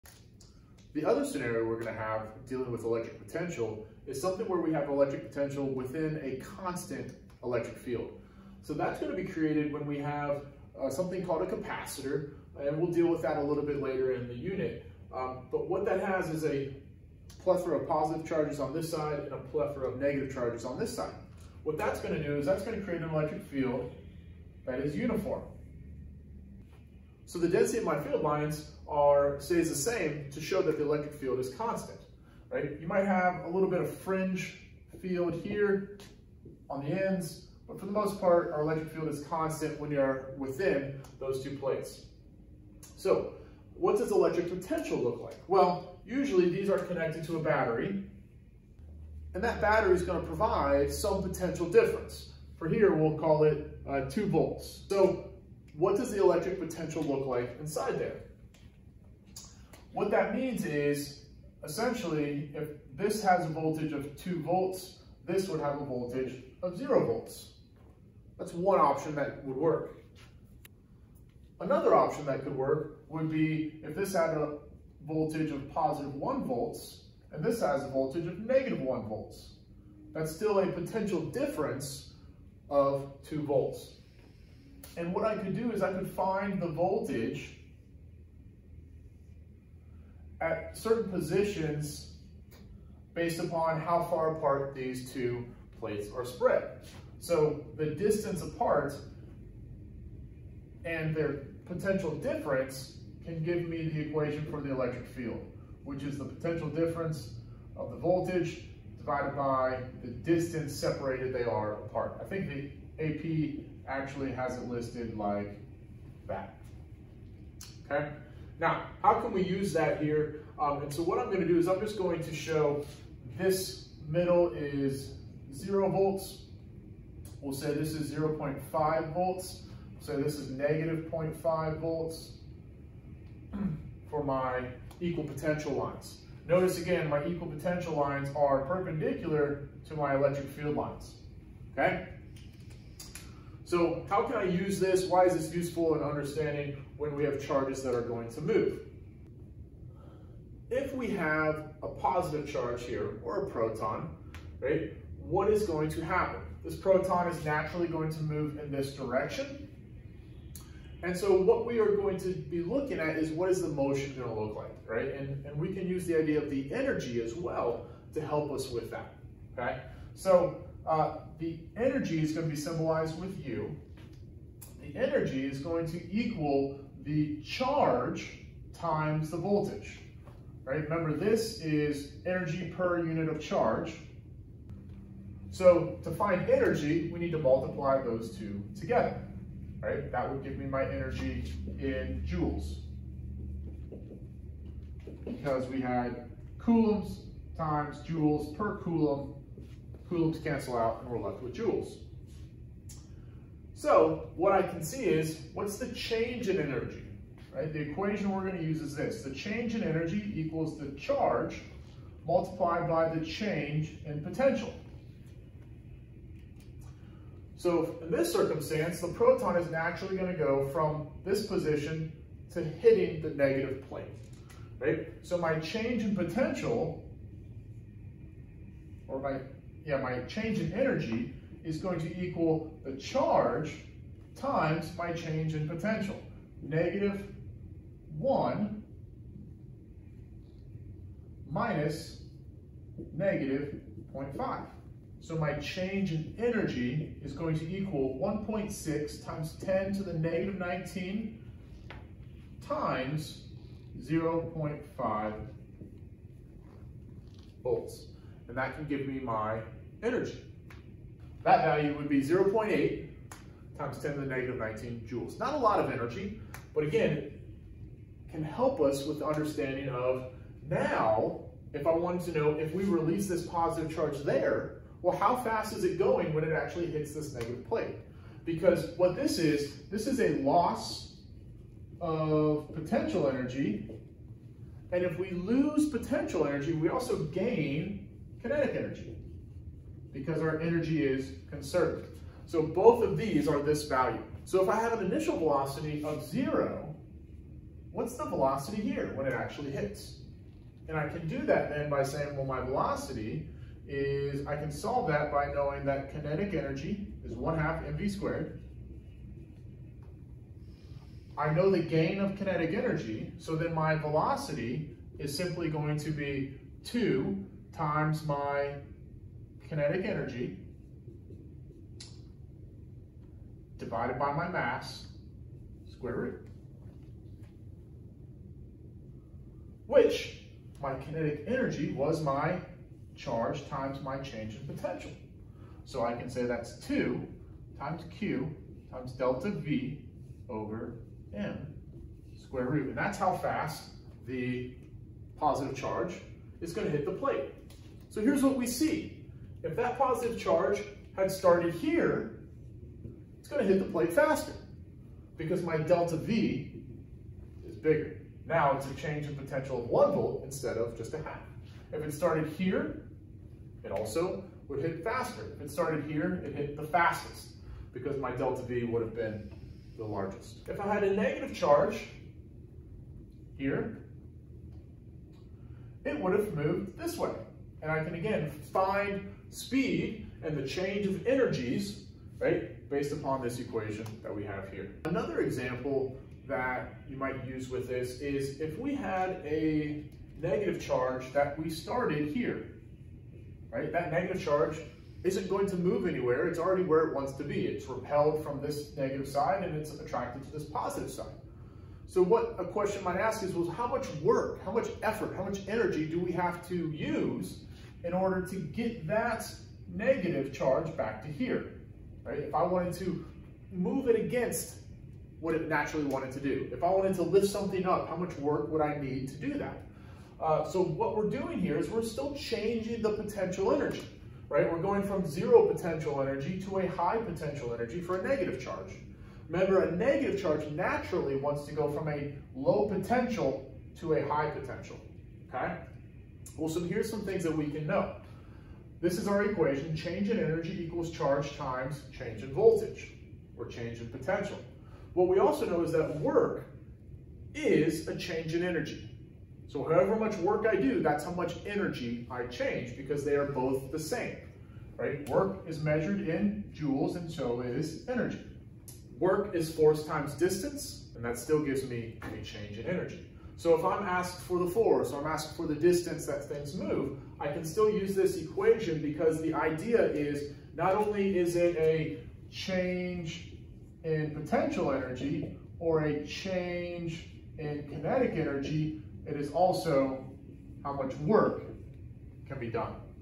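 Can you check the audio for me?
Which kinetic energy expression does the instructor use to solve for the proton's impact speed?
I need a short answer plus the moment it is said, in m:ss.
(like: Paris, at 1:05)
1/2 mv^2, at 5:07.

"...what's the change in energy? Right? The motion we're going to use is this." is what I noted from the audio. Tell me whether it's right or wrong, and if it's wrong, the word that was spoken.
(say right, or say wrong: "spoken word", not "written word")
wrong: "equation", not "motion".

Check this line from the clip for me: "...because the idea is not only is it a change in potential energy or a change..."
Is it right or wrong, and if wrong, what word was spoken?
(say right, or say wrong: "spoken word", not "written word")
right.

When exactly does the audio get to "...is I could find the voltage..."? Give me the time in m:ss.
1:25.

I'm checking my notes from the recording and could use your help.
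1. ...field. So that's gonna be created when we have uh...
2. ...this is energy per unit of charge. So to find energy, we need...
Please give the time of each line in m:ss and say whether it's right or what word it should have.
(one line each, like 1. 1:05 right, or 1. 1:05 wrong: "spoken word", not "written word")
1. 0:07 right
2. 3:01 right.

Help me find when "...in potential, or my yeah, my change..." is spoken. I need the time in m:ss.
3:46.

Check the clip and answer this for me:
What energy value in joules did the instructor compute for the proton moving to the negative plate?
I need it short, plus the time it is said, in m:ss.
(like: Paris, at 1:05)
0.8 times 10^-19 joules, at 4:22.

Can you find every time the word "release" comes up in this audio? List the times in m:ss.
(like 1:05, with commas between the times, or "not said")
4:32.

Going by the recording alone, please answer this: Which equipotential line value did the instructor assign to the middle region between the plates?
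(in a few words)
0 volts.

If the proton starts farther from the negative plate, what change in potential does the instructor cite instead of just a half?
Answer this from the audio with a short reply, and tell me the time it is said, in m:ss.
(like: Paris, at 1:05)
1 volt, at 5:59.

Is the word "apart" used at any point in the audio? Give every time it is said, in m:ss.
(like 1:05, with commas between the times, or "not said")
1:34, 1:38, 1:51.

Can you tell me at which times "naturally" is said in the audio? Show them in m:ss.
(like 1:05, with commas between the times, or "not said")
2:37, 3:39, 6:55, 7:10.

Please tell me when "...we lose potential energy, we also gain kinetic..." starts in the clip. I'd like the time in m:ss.
4:45.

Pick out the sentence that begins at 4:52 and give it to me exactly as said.
So both of these are this value.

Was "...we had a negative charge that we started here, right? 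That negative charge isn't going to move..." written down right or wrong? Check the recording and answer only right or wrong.
right.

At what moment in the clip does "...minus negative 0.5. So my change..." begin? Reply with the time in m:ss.
4:01.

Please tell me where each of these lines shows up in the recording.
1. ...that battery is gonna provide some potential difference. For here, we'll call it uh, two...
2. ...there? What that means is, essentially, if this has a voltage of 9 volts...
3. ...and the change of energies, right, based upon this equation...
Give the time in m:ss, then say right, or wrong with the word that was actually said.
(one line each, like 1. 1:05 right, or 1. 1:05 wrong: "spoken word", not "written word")
1. 0:49 right
2. 0:57 wrong: "2", not "9"
3. 6:20 right.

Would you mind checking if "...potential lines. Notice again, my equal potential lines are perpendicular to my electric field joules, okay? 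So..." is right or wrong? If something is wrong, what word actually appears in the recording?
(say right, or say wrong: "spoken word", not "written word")
wrong: "lines", not "joules".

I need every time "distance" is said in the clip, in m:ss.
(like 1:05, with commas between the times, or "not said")
1:37, 1:50, 7:40, 7:45.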